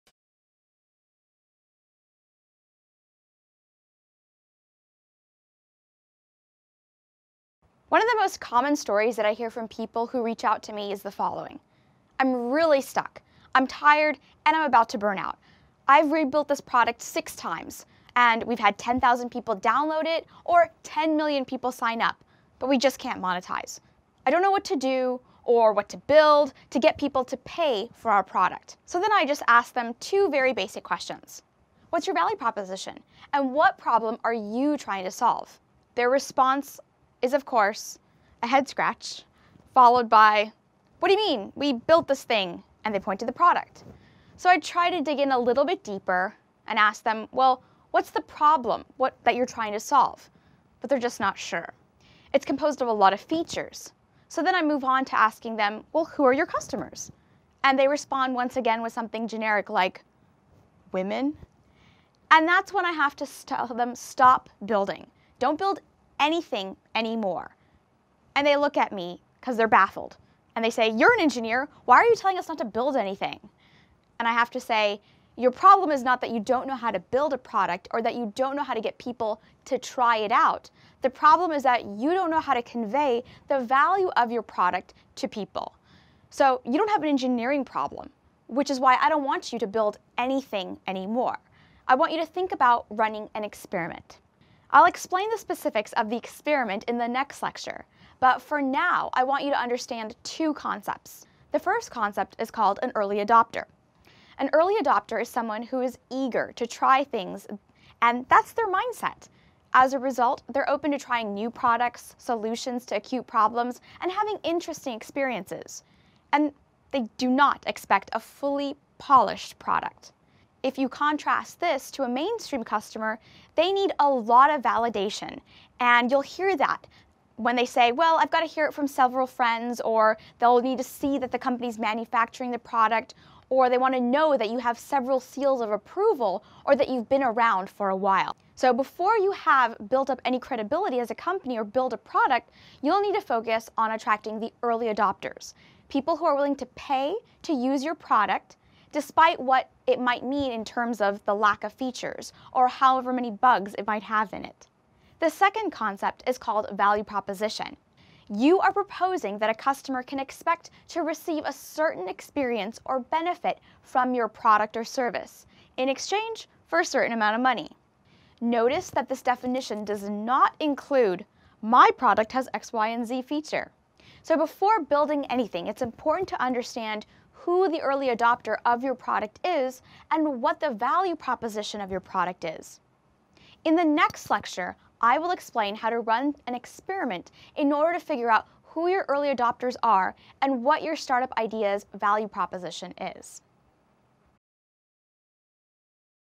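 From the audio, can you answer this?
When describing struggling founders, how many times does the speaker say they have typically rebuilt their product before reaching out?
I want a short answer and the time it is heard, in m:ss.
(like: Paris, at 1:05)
6, at 0:17.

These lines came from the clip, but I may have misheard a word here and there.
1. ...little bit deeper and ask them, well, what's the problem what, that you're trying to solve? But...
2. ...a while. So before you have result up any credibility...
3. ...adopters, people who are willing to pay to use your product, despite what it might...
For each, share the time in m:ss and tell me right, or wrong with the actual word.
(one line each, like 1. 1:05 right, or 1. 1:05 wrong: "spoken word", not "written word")
1. 0:45 right
2. 2:17 wrong: "built", not "result"
3. 2:24 right.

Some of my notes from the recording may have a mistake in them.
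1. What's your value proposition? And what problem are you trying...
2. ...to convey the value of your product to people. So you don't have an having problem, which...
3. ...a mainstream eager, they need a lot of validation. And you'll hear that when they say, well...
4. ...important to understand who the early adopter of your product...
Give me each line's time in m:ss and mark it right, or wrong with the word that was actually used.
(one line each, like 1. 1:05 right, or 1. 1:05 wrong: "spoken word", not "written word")
1. 0:31 right
2. 1:22 wrong: "engineering", not "having"
3. 2:02 wrong: "customer", not "eager"
4. 2:55 right.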